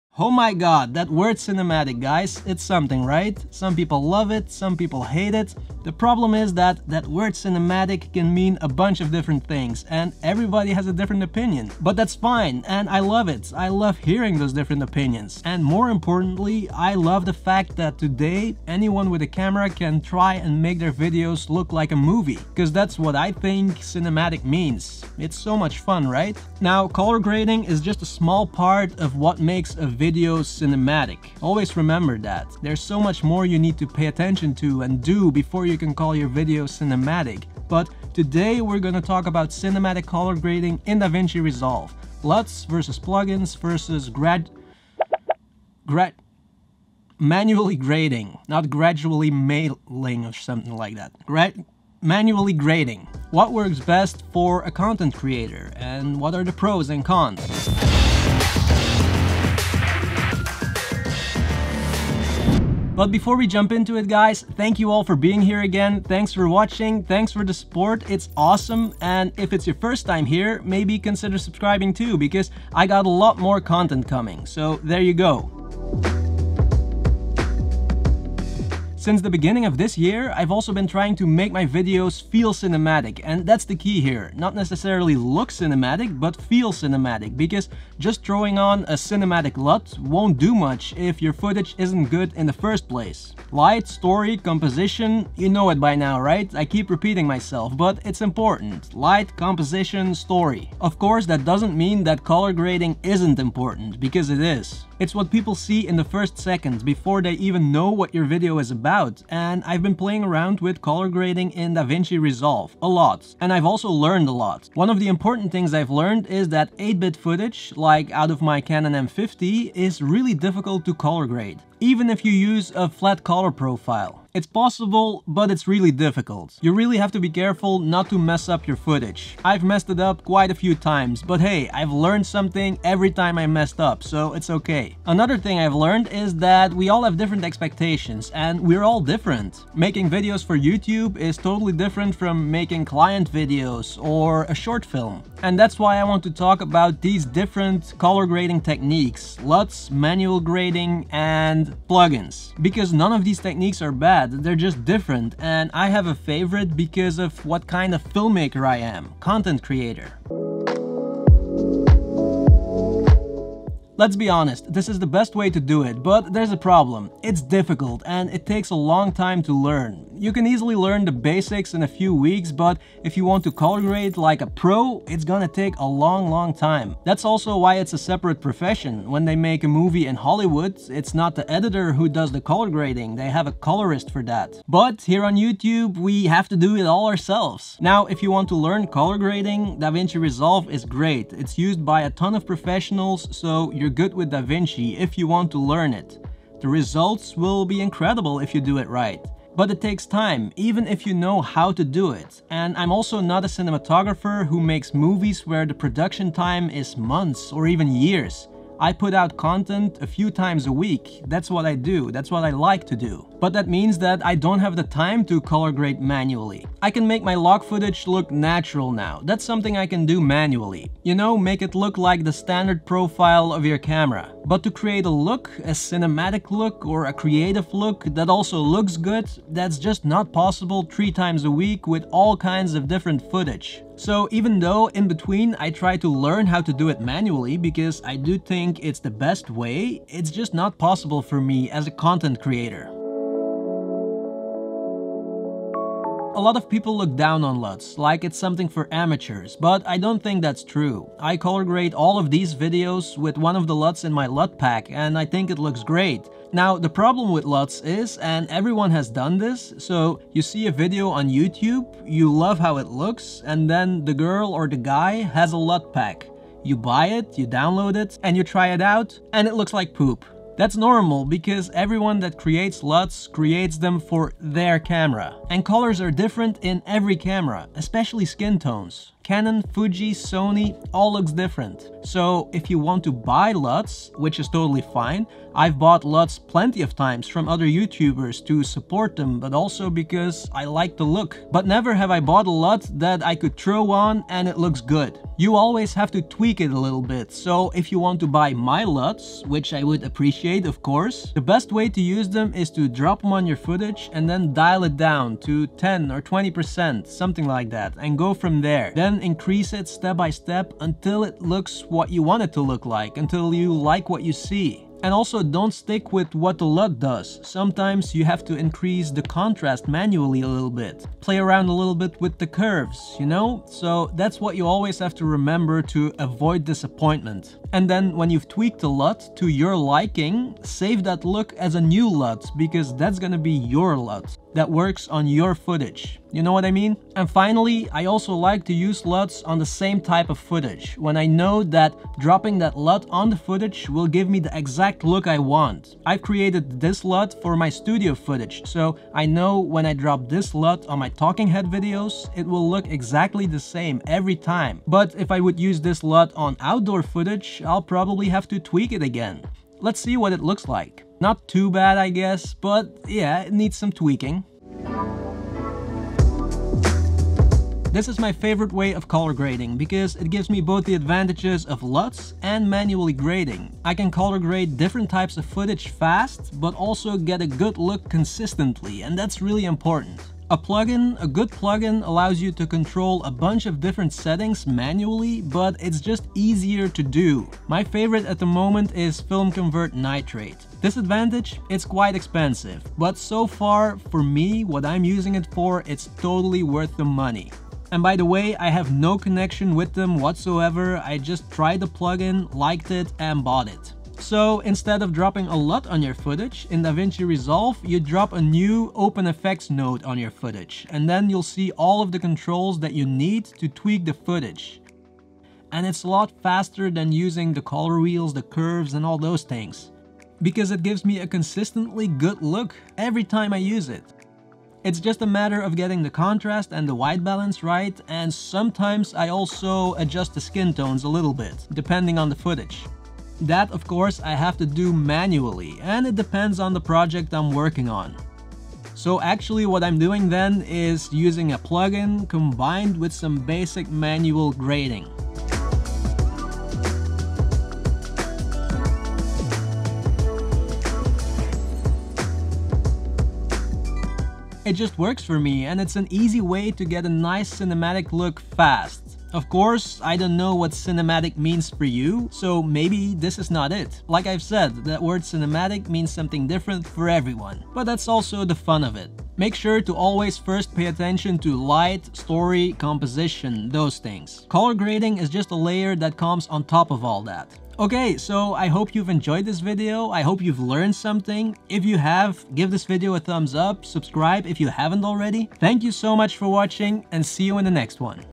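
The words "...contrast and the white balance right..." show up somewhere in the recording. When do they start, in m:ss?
7:06.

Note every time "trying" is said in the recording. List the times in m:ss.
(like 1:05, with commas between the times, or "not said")
1:20.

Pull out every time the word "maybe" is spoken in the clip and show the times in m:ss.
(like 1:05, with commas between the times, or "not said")
1:10, 7:42.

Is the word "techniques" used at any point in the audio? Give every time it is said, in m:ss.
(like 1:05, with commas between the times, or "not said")
2:28, 2:33.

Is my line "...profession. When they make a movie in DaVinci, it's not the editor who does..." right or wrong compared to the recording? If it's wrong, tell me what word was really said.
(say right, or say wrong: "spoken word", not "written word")
wrong: "Hollywood", not "DaVinci".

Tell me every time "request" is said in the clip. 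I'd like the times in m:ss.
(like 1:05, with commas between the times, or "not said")
not said.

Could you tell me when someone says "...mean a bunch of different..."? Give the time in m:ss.
0:08.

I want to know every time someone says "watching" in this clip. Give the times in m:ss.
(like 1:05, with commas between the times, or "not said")
1:06, 8:06.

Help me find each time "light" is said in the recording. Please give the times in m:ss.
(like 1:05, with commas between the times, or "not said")
1:33, 1:38, 7:51.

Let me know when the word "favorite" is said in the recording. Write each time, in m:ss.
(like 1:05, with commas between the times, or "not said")
2:36, 6:08, 6:27.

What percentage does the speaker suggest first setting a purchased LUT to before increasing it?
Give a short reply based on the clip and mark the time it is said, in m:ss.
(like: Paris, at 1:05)
10 or 20%, at 5:05.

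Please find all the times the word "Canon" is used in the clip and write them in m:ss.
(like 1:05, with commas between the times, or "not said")
1:58, 4:39.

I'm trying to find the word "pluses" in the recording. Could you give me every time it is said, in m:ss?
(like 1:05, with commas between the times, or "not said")
not said.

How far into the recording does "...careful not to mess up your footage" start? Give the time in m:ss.
2:07.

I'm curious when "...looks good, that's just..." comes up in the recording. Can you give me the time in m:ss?
3:48.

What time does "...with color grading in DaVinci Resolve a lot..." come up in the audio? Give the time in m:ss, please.
1:50.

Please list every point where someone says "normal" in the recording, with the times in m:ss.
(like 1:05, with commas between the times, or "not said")
4:30.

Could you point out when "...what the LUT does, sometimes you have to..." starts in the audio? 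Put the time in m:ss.
5:16.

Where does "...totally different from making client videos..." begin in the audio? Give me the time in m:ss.
2:21.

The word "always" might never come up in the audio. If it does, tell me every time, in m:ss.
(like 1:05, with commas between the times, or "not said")
0:31, 4:55, 5:24, 7:49.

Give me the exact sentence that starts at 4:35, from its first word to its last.
And colors are different in every camera, especially skin tones.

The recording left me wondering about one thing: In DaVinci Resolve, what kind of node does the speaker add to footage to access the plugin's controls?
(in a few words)
OpenFX node.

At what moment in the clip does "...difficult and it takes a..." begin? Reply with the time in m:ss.
2:47.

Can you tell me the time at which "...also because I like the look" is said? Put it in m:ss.
4:49.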